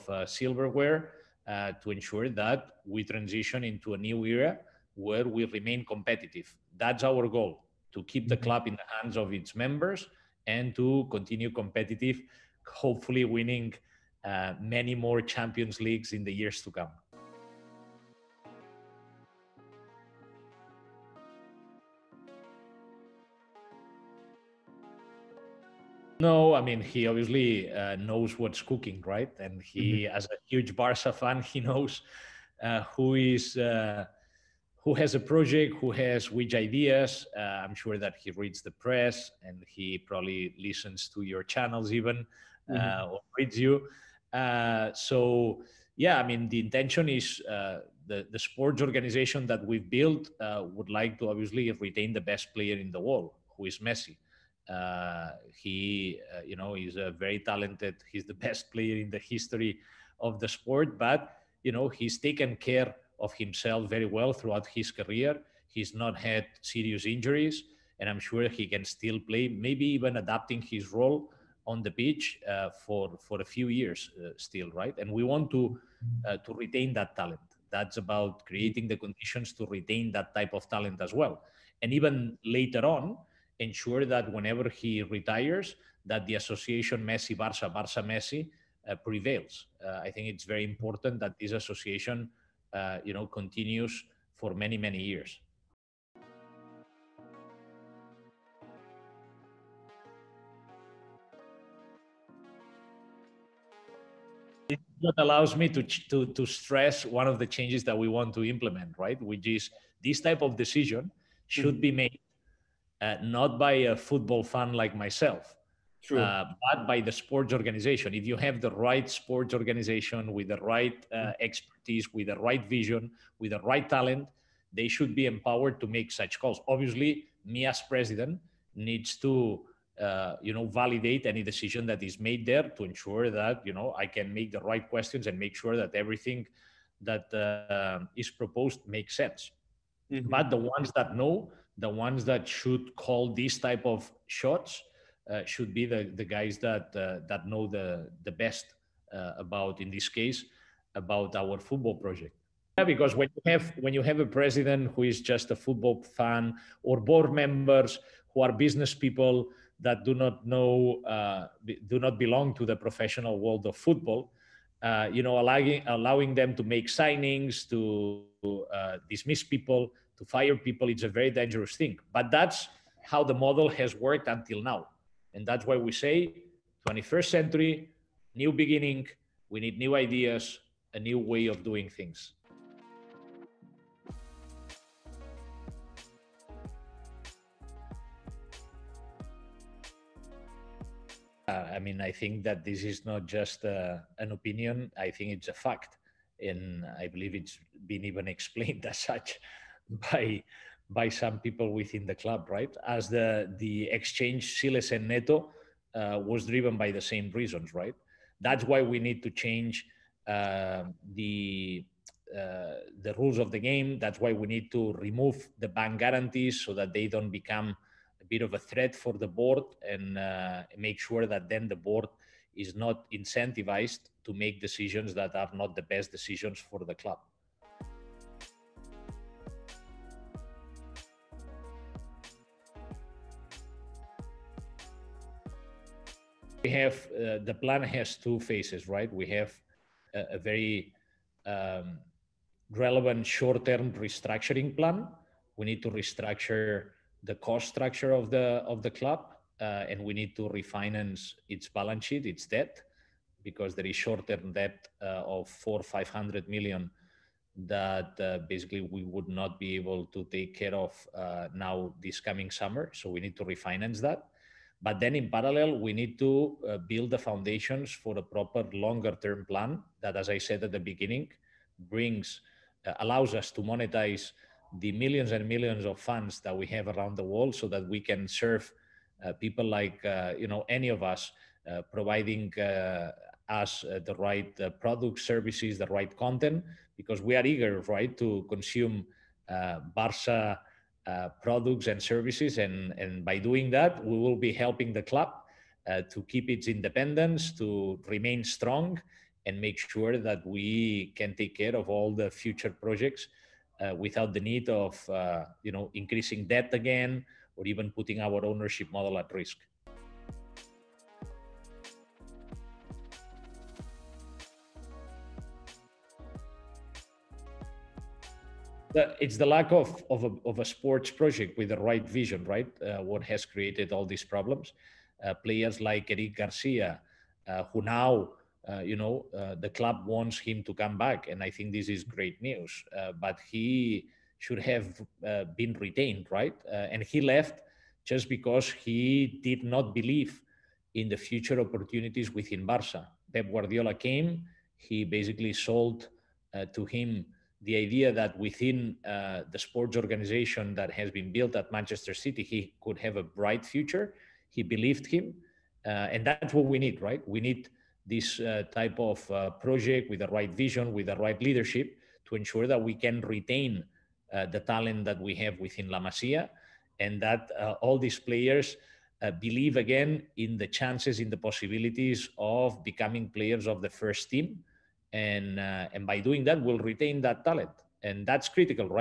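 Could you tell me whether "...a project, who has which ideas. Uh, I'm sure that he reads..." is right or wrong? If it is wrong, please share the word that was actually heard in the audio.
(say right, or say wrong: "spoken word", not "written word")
right.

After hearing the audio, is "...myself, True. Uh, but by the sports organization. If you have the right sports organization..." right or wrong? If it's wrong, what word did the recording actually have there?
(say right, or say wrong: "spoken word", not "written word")
right.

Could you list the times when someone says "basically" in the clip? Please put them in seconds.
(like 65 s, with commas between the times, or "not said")
258 s, 345 s.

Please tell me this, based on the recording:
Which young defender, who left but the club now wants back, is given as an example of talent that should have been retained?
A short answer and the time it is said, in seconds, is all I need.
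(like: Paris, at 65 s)
Eric Garcia, at 326 s.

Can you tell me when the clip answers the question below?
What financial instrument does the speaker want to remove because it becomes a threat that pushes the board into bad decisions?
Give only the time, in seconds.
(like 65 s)
215 s.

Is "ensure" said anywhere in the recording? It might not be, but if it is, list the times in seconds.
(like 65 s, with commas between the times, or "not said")
1 s, 83 s, 132 s, 362 s.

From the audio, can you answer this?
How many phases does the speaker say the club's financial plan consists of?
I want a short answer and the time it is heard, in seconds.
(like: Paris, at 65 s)
2, at 238 s.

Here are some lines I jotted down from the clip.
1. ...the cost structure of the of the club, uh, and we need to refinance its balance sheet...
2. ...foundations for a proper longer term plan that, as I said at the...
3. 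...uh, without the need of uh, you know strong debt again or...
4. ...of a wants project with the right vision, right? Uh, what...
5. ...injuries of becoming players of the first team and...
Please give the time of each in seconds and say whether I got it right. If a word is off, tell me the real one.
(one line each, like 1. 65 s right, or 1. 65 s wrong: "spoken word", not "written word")
1. 247 s right
2. 267 s right
3. 303 s wrong: "increasing", not "strong"
4. 320 s wrong: "sports", not "wants"
5. 371 s wrong: "possibilities", not "injuries".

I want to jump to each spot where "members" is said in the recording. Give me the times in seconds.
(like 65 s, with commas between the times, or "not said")
9 s, 157 s.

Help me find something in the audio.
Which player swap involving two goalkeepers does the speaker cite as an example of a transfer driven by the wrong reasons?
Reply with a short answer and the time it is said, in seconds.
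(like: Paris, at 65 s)
Cillessen and Neto, at 204 s.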